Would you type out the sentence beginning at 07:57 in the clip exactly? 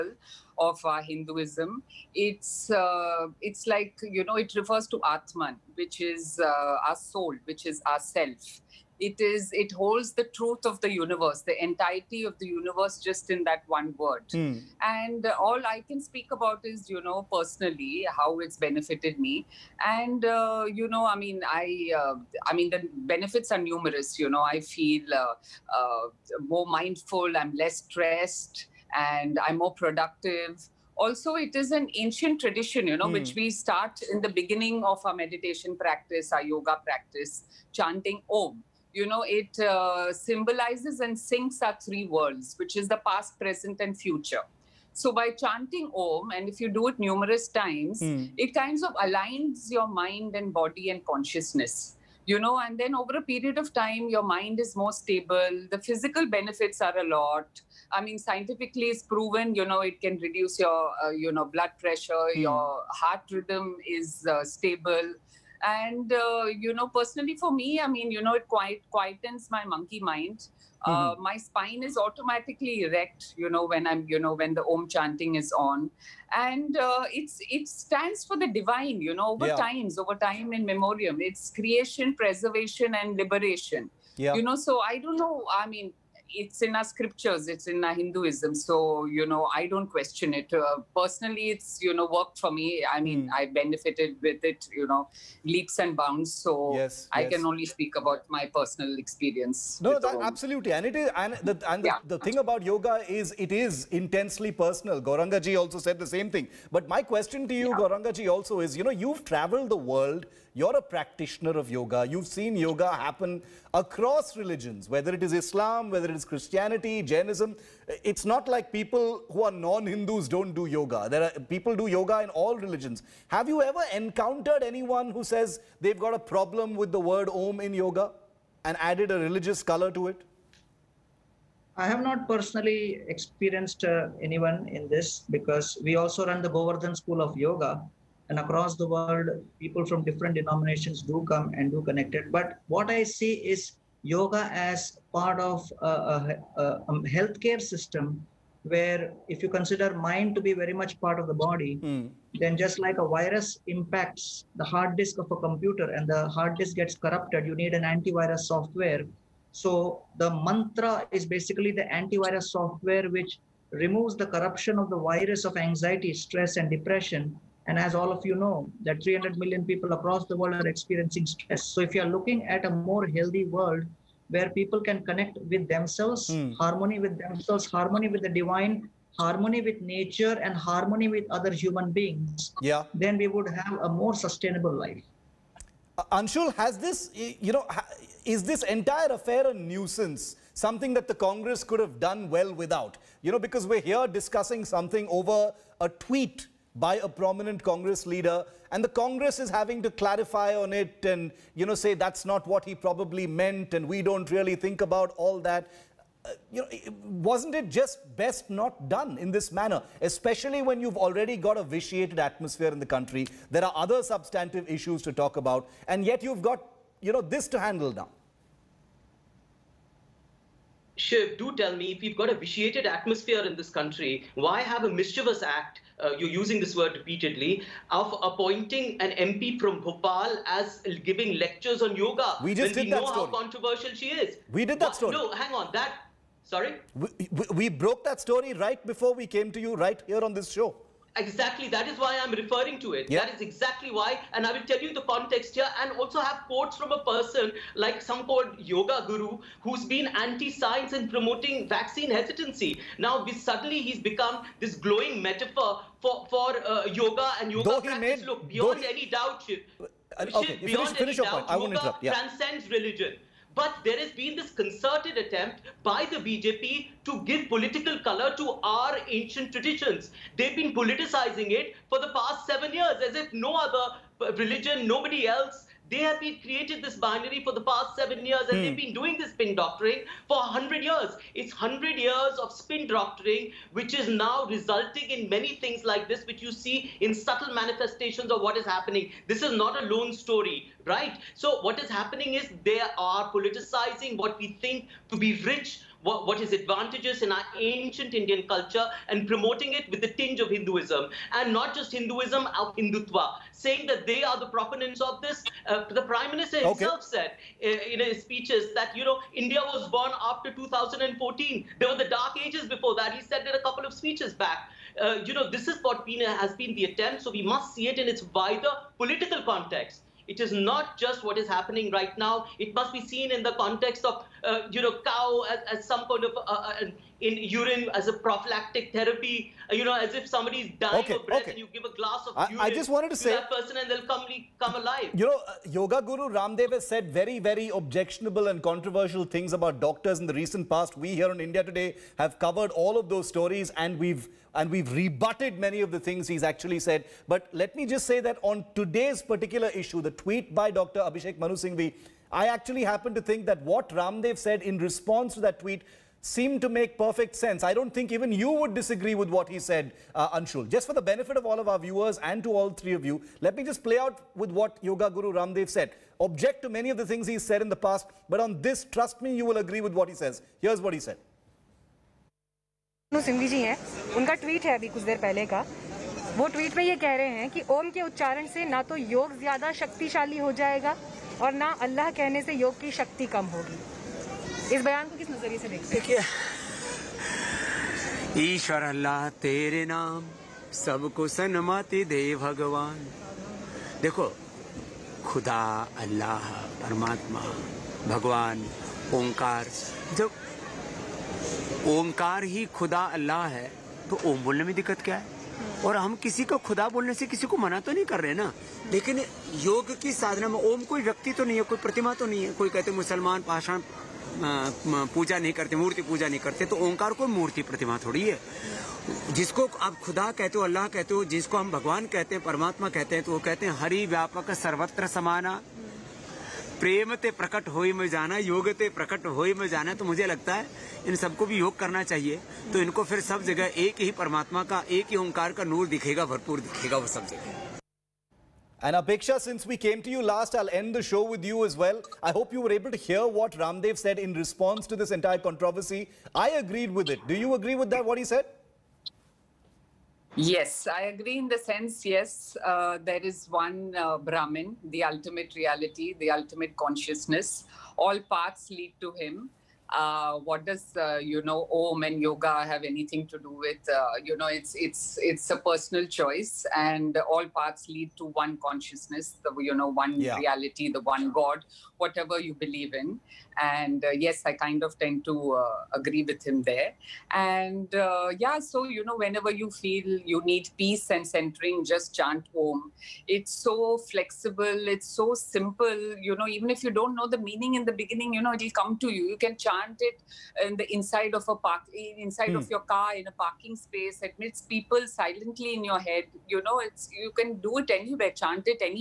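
And uh, yeah, so, you know, whenever you feel you need peace and centering, just chant Om.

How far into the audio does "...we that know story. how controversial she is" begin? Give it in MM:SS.
03:52.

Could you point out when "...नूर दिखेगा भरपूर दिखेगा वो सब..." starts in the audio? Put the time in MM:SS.
07:15.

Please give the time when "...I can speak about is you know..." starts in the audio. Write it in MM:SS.
00:15.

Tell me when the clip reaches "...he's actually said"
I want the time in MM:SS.
05:46.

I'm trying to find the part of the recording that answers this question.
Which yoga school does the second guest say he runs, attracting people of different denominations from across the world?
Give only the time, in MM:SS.
02:16.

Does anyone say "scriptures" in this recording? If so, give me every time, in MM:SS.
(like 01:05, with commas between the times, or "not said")
01:26.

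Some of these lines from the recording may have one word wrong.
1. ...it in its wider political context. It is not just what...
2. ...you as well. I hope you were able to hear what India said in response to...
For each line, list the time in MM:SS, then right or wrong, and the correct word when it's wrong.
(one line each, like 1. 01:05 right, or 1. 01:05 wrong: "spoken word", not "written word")
1. 05:17 right
2. 07:21 wrong: "Ramdev", not "India".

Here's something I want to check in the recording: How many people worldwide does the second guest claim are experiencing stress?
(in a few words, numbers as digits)
300 million.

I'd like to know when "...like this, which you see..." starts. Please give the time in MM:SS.
04:45.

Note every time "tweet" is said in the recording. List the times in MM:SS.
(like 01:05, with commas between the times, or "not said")
03:15, 05:50, 05:55.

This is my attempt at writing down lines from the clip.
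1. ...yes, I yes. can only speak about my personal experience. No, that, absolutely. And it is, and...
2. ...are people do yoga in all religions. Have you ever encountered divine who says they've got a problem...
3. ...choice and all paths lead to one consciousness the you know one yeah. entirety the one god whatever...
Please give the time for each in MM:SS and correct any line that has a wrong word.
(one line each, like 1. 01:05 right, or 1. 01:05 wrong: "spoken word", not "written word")
1. 01:36 right
2. 02:01 wrong: "anyone", not "divine"
3. 07:46 wrong: "reality", not "entirety".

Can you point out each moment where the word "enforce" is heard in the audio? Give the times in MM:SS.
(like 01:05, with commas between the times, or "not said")
not said.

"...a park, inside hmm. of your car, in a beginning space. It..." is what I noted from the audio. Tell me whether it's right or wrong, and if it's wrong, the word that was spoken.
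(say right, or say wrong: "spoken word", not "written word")
wrong: "parking", not "beginning".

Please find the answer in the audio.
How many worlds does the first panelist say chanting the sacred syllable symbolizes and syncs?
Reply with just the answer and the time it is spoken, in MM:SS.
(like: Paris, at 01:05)
3, at 00:41.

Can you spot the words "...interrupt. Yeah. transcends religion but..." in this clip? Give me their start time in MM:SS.
04:21.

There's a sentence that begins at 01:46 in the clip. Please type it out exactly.
But my question to you, yeah.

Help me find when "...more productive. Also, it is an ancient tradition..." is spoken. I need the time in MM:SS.
00:29.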